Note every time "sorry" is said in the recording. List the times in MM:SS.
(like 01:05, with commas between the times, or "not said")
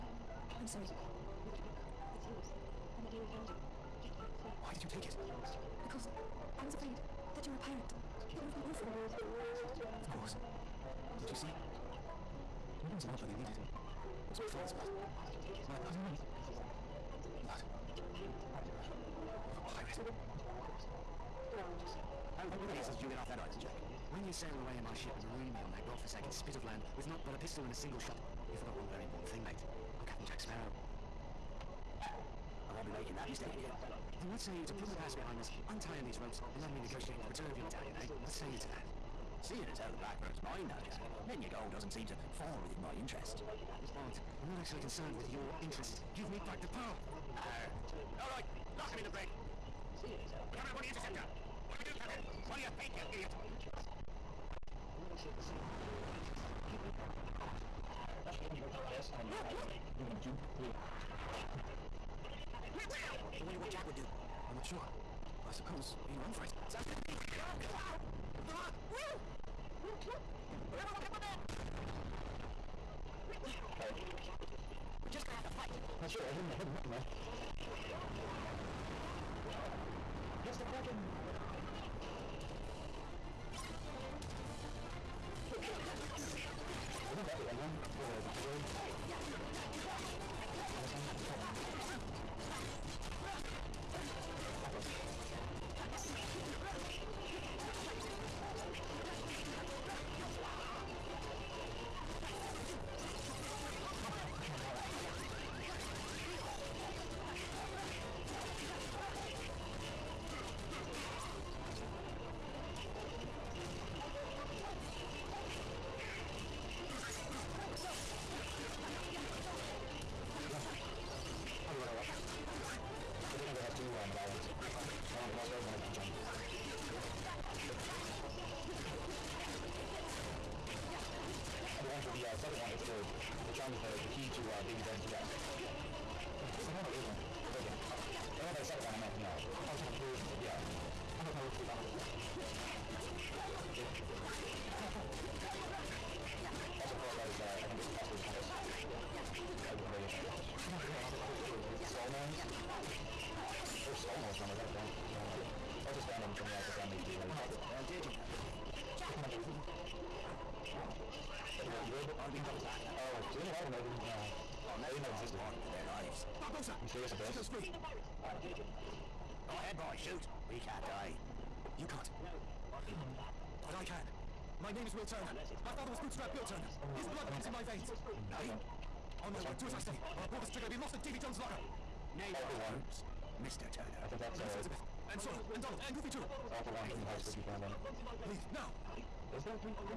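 00:00, 01:13.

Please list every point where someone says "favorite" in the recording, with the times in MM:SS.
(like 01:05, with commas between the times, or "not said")
02:31.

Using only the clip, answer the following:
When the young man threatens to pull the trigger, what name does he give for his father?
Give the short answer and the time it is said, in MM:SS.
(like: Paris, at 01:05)
Bootstrap Bill Turner, at 02:56.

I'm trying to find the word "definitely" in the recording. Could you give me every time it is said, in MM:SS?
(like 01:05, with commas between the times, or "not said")
not said.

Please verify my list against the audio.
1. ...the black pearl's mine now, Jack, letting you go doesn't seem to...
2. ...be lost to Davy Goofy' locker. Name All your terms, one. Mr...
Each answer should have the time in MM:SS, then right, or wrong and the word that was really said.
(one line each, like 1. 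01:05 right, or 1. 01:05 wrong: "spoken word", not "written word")
1. 00:39 right
2. 03:00 wrong: "Jones", not "Goofy".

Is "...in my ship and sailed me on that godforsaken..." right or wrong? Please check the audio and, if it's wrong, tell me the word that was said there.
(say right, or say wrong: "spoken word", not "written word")
wrong: "marooned", not "sailed".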